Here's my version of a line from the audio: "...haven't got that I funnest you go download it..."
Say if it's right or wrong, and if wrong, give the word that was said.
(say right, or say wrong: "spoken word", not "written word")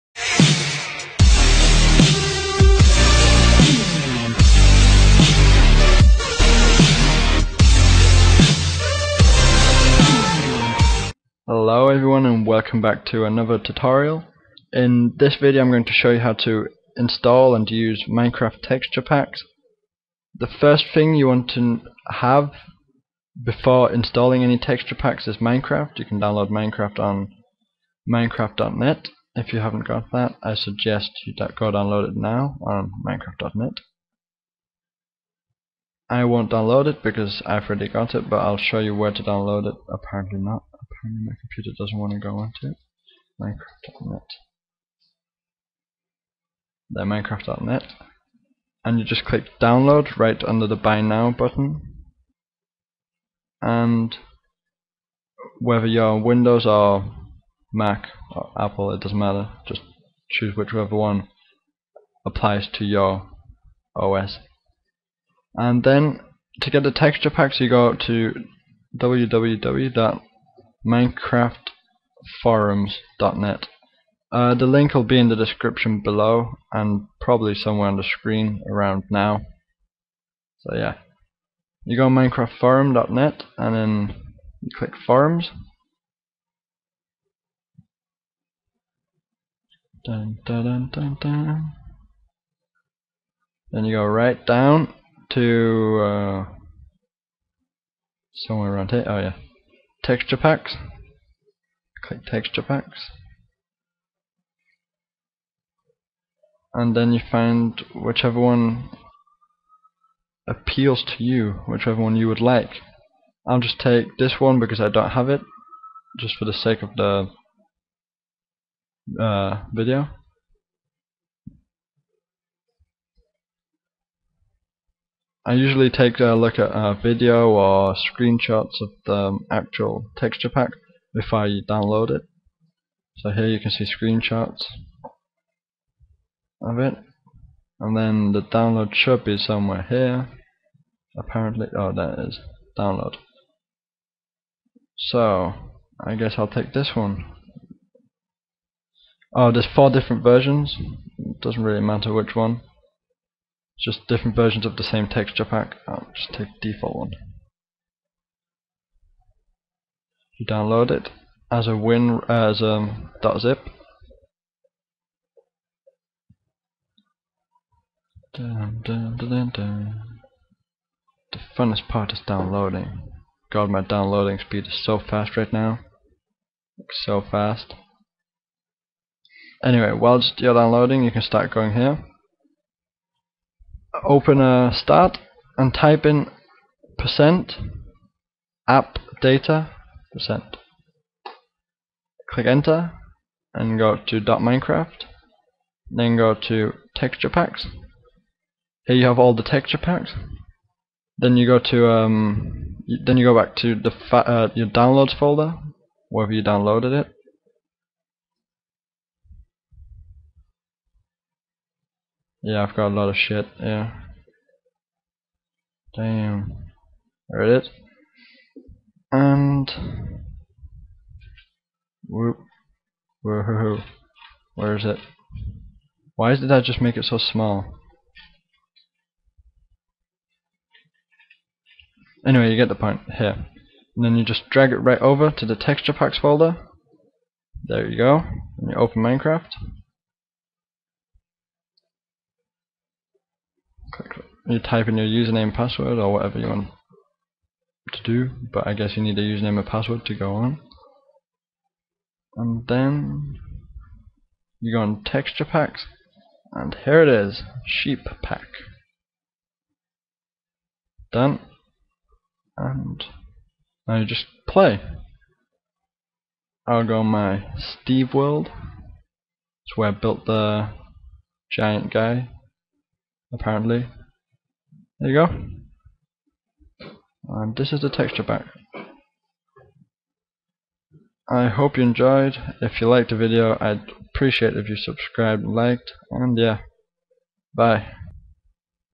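wrong: "suggest", not "funnest".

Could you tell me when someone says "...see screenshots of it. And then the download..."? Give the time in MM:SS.
02:13.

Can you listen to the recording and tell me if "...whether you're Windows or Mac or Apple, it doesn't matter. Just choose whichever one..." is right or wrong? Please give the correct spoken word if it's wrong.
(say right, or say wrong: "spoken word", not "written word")
right.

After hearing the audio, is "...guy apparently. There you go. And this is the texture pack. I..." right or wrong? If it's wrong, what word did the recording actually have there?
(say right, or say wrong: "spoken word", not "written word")
right.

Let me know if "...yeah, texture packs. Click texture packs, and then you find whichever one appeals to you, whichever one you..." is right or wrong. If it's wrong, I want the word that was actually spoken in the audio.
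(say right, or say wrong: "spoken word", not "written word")
right.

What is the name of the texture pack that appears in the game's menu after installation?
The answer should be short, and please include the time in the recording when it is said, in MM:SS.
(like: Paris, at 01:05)
sheep pack, at 04:17.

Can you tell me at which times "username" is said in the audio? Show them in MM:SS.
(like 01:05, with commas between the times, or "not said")
04:05, 04:09.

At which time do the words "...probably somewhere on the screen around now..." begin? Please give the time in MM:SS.
01:17.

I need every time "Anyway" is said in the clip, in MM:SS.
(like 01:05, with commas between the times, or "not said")
02:59, 03:52.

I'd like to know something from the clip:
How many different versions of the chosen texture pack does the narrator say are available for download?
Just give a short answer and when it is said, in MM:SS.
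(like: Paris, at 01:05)
4, at 02:29.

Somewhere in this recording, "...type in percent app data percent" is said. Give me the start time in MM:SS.
03:05.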